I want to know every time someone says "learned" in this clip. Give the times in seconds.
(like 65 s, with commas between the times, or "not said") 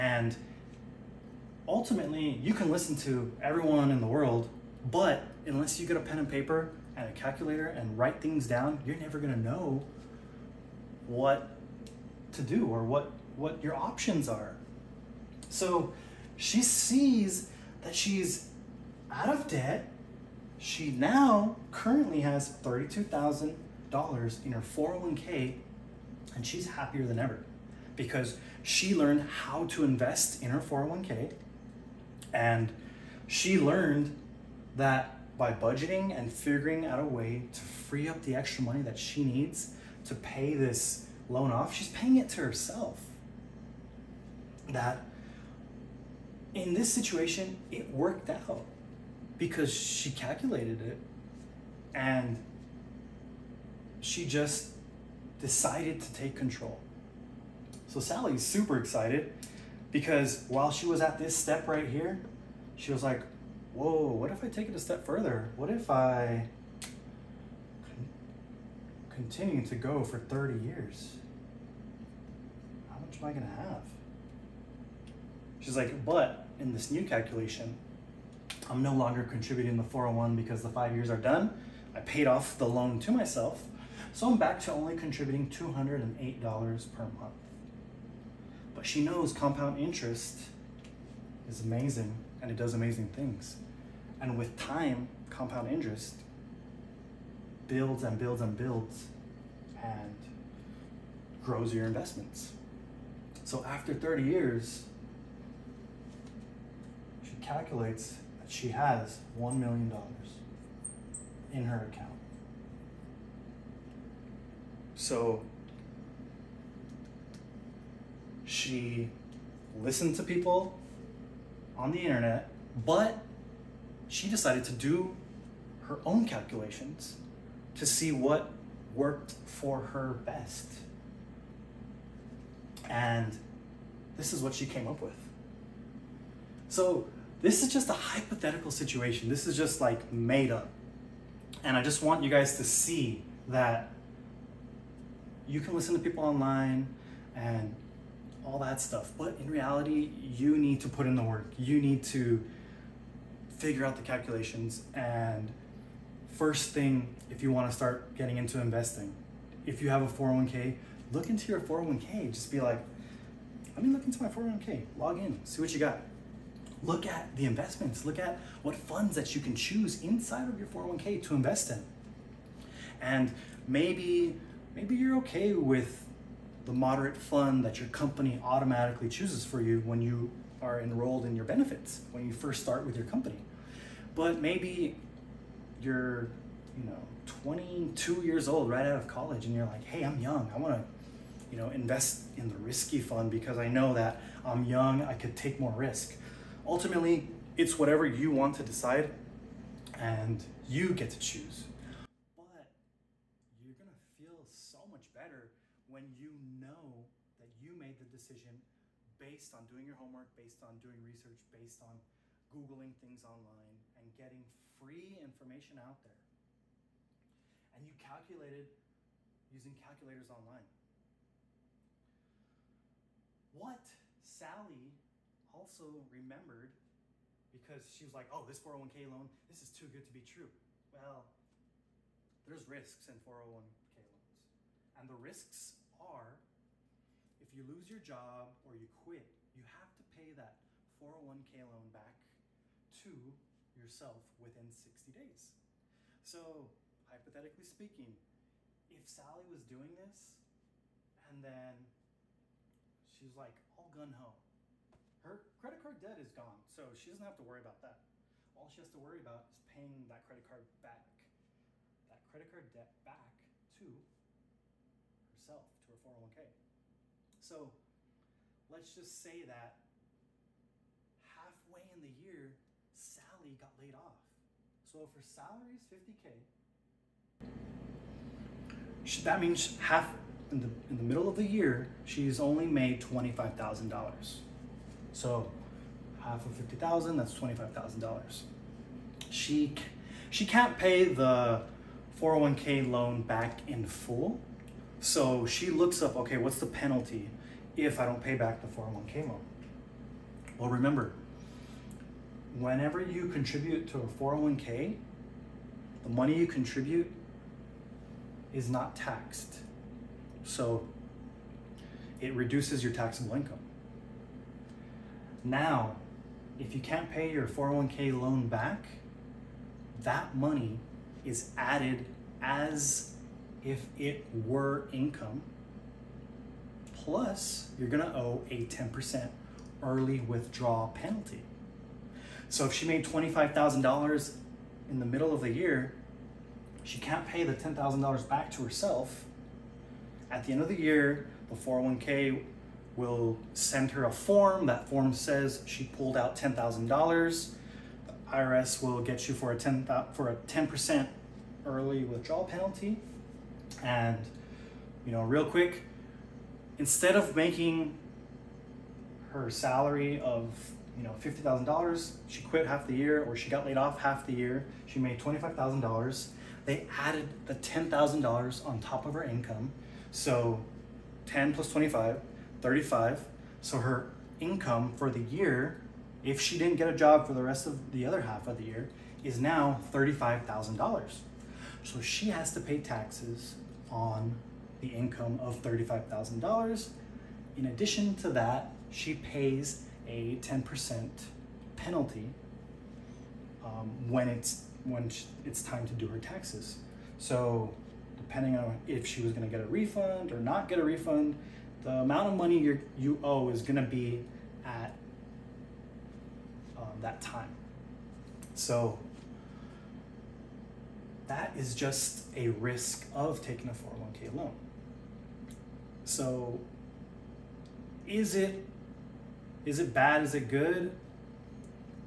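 28 s, 33 s.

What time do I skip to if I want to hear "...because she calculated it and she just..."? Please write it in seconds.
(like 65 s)
49 s.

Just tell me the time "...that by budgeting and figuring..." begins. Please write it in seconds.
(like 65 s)
34 s.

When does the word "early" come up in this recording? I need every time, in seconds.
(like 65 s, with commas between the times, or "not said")
329 s, 351 s.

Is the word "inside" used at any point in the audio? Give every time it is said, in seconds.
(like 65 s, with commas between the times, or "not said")
170 s.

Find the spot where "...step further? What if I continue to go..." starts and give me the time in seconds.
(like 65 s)
64 s.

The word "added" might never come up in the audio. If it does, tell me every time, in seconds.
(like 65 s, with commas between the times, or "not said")
321 s, 366 s.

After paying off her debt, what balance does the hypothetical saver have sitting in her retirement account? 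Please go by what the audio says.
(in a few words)
$32,000.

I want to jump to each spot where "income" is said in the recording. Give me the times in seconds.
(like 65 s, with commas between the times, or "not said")
313 s, 324 s, 369 s, 374 s, 384 s.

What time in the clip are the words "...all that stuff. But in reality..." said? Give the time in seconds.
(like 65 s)
148 s.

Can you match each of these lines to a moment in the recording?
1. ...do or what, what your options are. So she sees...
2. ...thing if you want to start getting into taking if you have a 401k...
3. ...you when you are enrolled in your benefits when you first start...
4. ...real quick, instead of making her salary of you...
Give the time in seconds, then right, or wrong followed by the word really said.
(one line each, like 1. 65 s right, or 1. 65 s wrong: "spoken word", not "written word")
1. 12 s right
2. 156 s wrong: "investing", not "taking"
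3. 179 s right
4. 355 s right.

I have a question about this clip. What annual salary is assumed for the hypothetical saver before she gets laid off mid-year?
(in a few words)
$50,000.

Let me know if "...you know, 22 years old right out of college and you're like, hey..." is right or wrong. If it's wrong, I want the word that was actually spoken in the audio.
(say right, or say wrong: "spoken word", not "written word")
right.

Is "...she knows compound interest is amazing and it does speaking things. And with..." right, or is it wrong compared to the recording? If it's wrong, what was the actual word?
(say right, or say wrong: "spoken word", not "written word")
wrong: "amazing", not "speaking".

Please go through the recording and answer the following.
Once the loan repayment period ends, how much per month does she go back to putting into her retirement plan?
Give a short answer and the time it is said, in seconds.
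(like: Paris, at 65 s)
$208, at 85 s.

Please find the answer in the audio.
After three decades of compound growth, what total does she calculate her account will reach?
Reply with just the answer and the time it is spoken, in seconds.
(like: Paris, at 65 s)
$1 million, at 109 s.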